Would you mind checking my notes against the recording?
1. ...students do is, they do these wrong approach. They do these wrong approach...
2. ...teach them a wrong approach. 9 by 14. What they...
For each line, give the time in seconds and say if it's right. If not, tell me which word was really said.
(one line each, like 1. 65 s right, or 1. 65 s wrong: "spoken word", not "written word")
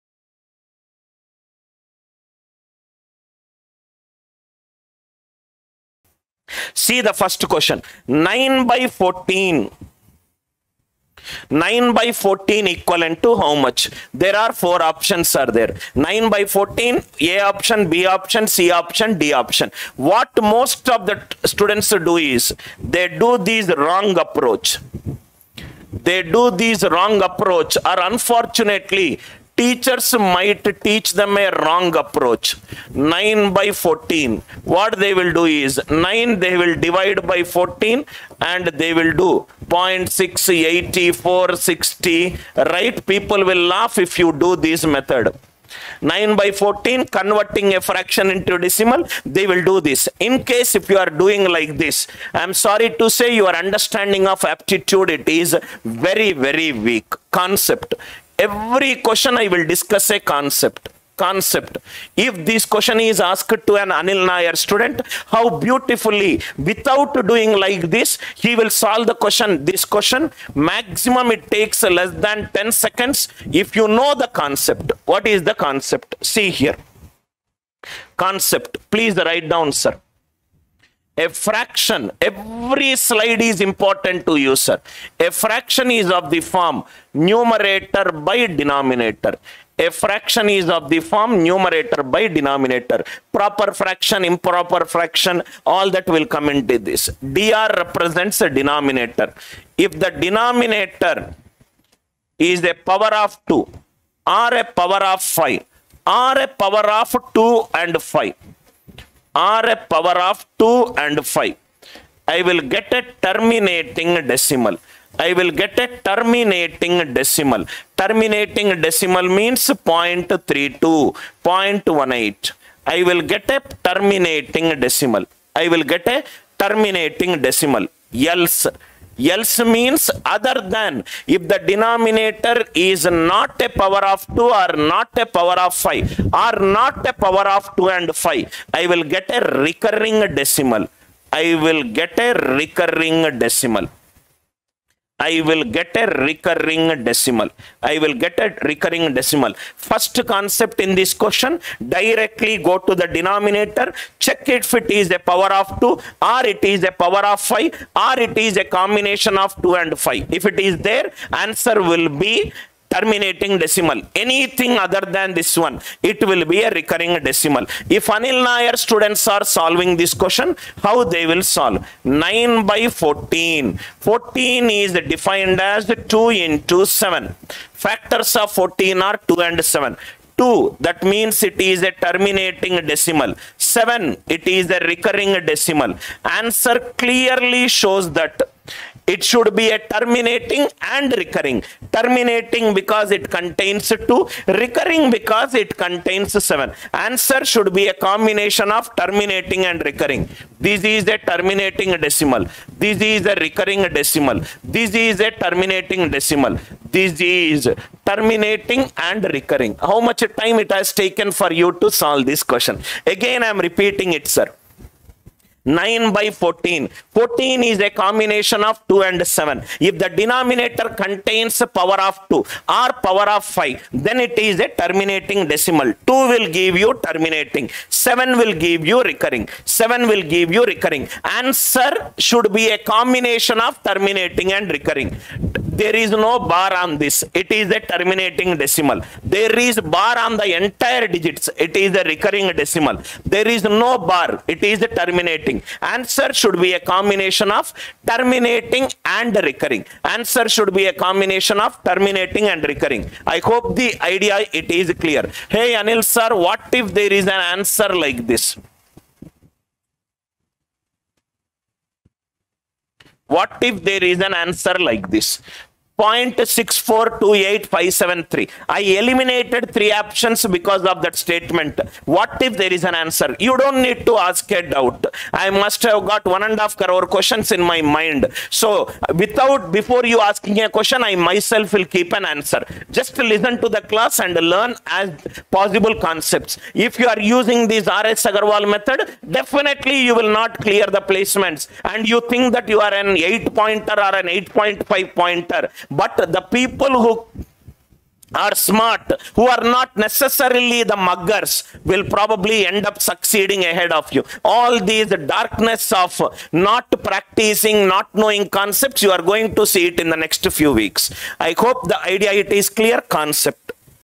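1. 21 s right
2. 30 s right.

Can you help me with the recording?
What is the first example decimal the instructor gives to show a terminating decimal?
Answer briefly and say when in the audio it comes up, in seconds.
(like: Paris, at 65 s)
0.32, at 119 s.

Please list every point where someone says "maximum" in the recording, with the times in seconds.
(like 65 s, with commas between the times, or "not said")
70 s.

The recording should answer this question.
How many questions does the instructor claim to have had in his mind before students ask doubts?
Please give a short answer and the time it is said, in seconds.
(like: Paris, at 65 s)
1.5 crore, at 276 s.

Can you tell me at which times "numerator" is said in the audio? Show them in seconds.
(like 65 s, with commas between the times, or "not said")
87 s, 91 s.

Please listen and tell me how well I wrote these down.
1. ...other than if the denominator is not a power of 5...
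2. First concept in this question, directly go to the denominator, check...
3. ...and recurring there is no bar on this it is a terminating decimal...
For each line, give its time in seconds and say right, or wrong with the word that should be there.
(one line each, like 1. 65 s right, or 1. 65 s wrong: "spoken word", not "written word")
1. 130 s wrong: "2", not "5"
2. 149 s right
3. 234 s right.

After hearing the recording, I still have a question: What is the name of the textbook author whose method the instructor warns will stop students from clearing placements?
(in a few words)
RS Agarwal.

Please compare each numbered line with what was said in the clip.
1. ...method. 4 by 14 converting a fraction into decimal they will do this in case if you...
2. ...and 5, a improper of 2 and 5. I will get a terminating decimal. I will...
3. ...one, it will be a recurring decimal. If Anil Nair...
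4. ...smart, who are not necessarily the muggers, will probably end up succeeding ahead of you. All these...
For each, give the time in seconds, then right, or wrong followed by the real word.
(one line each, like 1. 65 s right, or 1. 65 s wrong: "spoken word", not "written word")
1. 44 s wrong: "9", not "4"
2. 107 s wrong: "power", not "improper"
3. 165 s right
4. 298 s right.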